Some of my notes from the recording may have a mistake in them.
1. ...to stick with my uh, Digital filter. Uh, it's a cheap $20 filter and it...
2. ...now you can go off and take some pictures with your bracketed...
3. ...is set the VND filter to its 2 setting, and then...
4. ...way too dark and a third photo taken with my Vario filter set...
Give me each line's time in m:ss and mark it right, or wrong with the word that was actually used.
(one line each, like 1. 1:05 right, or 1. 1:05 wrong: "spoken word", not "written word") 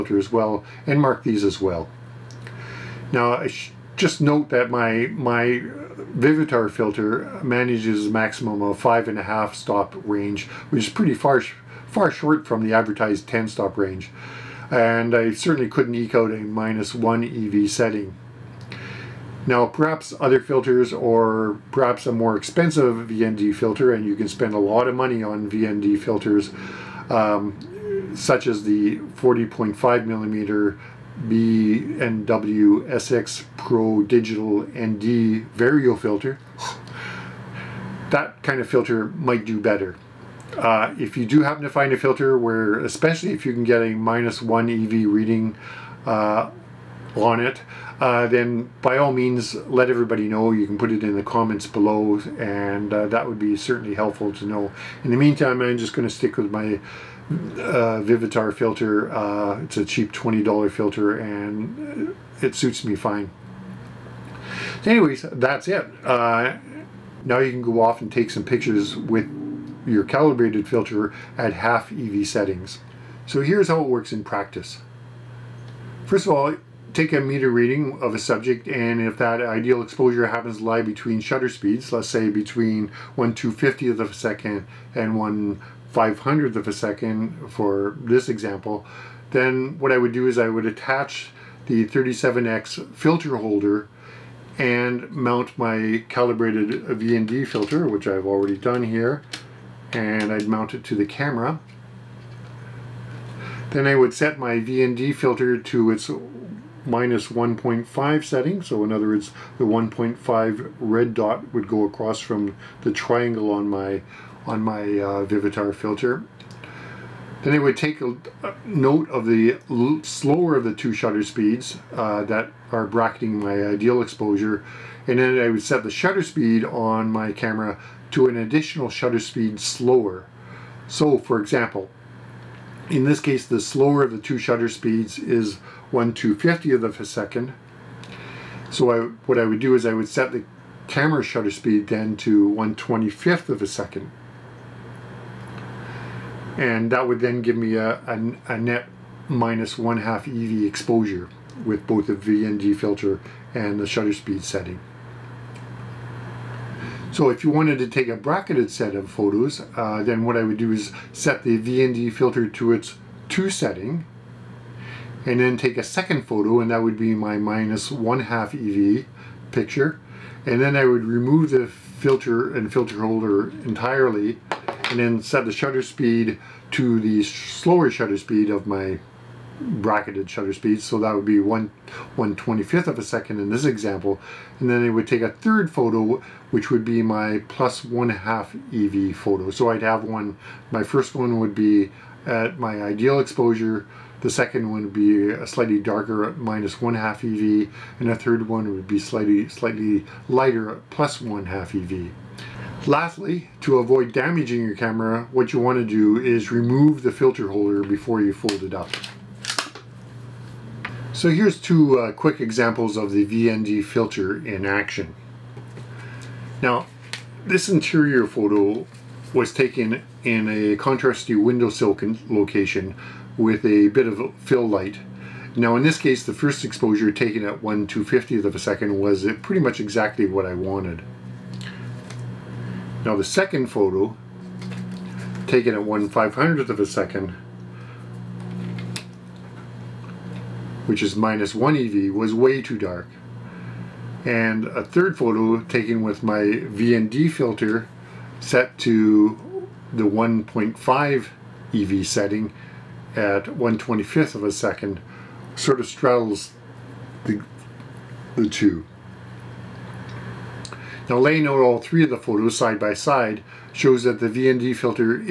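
1. 0:56 wrong: "Vivitar", not "Digital"
2. 1:07 wrong: "calibrated", not "bracketed"
3. 2:40 right
4. 4:02 wrong: "VND", not "Vario".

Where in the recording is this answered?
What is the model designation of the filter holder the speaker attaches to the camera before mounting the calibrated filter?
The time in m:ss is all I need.
1:31.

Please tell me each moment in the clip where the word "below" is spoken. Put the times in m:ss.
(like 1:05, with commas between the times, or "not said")
0:51.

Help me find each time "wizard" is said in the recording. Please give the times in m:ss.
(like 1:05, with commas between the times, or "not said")
not said.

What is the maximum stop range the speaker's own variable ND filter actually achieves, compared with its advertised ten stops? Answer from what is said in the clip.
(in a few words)
5.5 stop.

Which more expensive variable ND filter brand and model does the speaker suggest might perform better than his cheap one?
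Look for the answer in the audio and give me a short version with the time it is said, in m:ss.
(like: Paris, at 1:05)
B+W SX Pro Digital ND Vario, at 0:31.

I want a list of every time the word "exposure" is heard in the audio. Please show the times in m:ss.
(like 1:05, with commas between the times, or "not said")
1:19, 2:04, 2:30, 3:13, 3:46.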